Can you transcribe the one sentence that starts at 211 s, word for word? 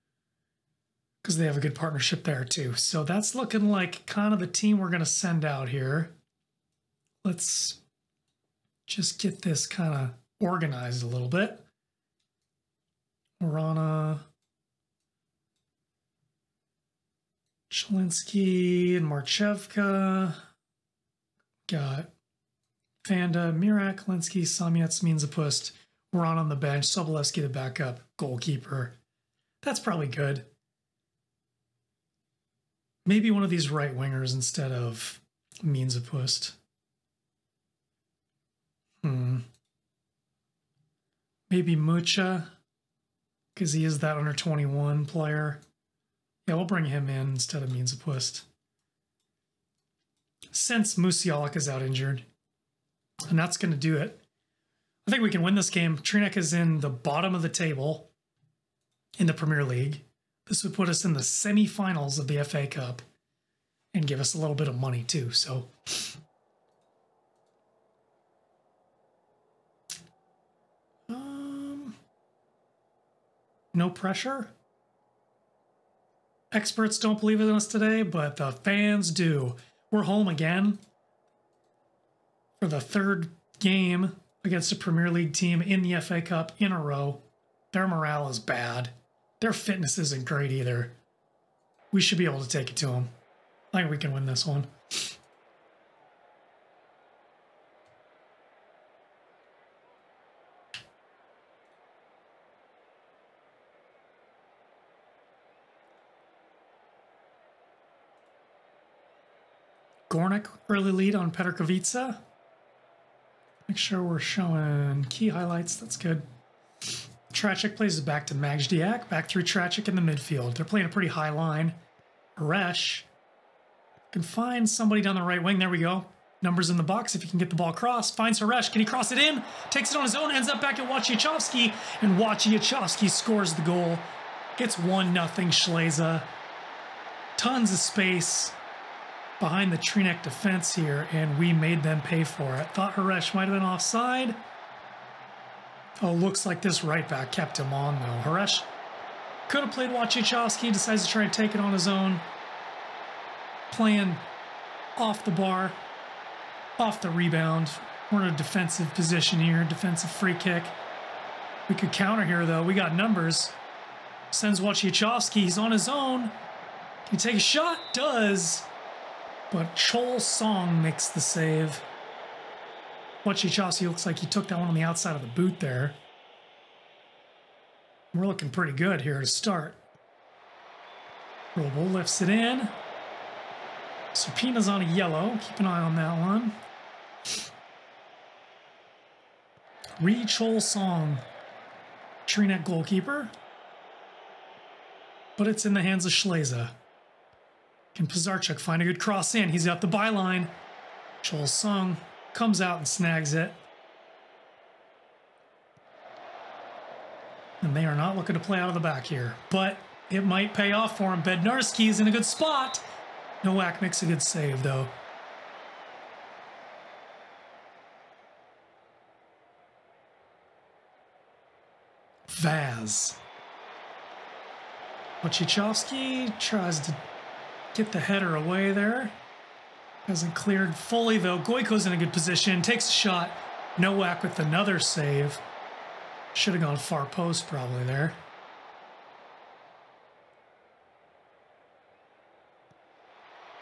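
Bednarski is in a good spot.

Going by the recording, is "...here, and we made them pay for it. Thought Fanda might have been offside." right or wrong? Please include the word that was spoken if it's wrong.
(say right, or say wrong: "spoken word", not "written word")
wrong: "Haresh", not "Fanda".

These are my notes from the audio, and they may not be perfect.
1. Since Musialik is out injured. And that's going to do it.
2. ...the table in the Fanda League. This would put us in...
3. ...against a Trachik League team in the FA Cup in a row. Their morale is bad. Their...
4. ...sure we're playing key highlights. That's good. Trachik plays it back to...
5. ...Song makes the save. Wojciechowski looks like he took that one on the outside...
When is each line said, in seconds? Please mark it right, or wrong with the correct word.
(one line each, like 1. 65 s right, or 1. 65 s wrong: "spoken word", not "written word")
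1. 50 s right
2. 57 s wrong: "Premier", not "Fanda"
3. 84 s wrong: "Premier", not "Trachik"
4. 113 s wrong: "showing", not "playing"
5. 170 s right.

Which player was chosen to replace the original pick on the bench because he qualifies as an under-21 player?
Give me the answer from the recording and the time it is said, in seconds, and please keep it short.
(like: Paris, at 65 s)
Mucha, at 41 s.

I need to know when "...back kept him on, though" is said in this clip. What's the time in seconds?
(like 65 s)
147 s.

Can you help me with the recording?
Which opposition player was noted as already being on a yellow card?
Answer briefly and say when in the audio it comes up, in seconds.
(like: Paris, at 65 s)
Supina, at 184 s.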